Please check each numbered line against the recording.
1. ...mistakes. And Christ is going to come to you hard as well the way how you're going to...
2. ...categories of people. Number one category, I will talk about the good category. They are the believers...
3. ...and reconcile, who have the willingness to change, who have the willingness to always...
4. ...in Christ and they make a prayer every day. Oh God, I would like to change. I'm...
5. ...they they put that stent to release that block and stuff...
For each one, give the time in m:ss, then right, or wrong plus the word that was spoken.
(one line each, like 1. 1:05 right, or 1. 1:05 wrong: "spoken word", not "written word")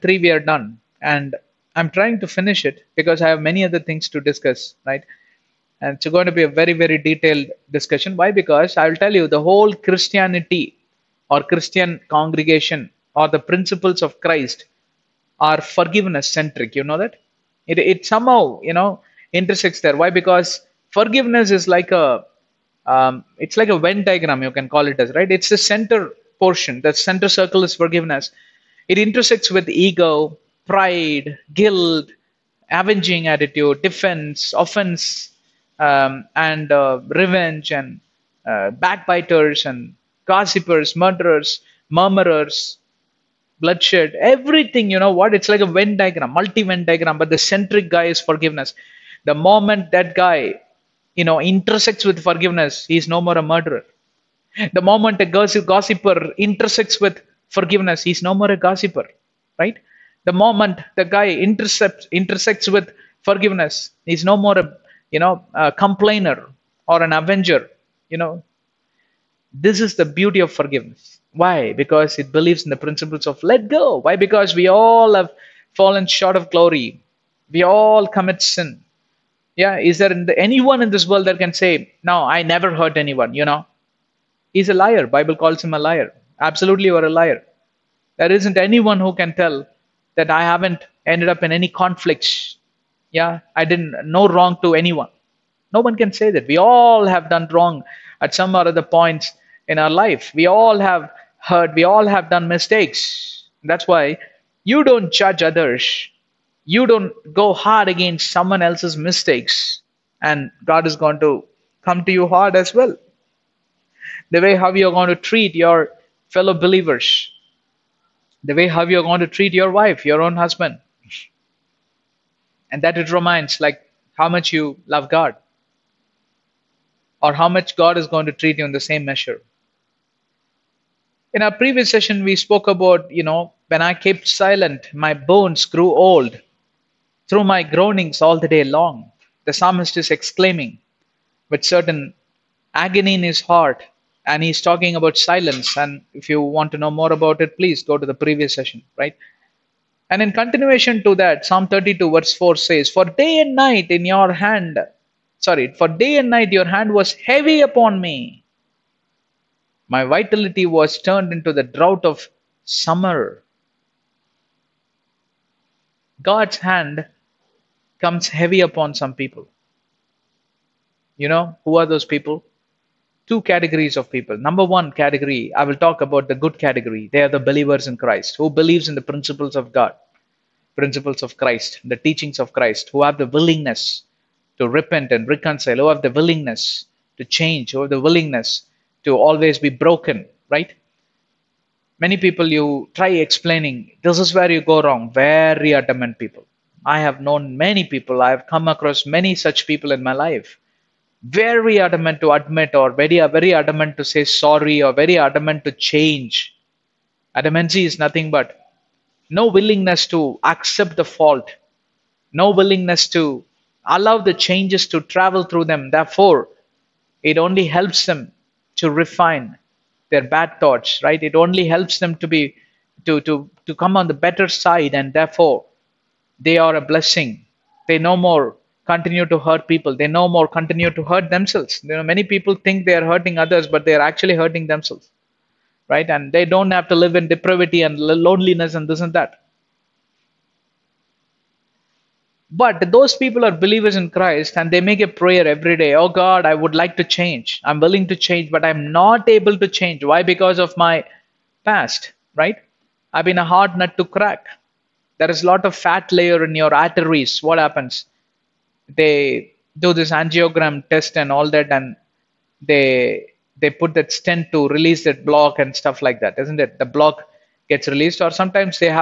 1. 1:48 wrong: "God", not "Christ"
2. 2:53 right
3. 3:05 right
4. 4:03 right
5. 4:22 right.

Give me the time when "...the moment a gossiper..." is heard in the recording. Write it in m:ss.
0:54.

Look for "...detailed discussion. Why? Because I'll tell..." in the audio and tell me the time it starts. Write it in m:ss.
0:06.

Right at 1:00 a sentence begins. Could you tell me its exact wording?
The moment the guy intercepts, intersects with forgiveness, he's no more a you know a complainer or an avenger.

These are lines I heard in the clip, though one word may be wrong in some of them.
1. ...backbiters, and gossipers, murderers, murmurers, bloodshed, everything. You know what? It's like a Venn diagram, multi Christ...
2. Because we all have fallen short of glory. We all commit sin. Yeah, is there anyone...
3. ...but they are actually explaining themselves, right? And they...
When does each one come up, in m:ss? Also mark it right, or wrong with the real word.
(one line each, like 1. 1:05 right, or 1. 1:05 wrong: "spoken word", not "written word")
1. 0:38 wrong: "Venn", not "Christ"
2. 1:14 right
3. 3:53 wrong: "hurting", not "explaining".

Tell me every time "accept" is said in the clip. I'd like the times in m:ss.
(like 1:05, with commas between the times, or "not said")
3:30.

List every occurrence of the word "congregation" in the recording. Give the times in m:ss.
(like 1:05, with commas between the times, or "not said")
0:12.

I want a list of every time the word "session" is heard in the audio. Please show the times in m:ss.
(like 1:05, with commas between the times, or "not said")
2:11, 2:28.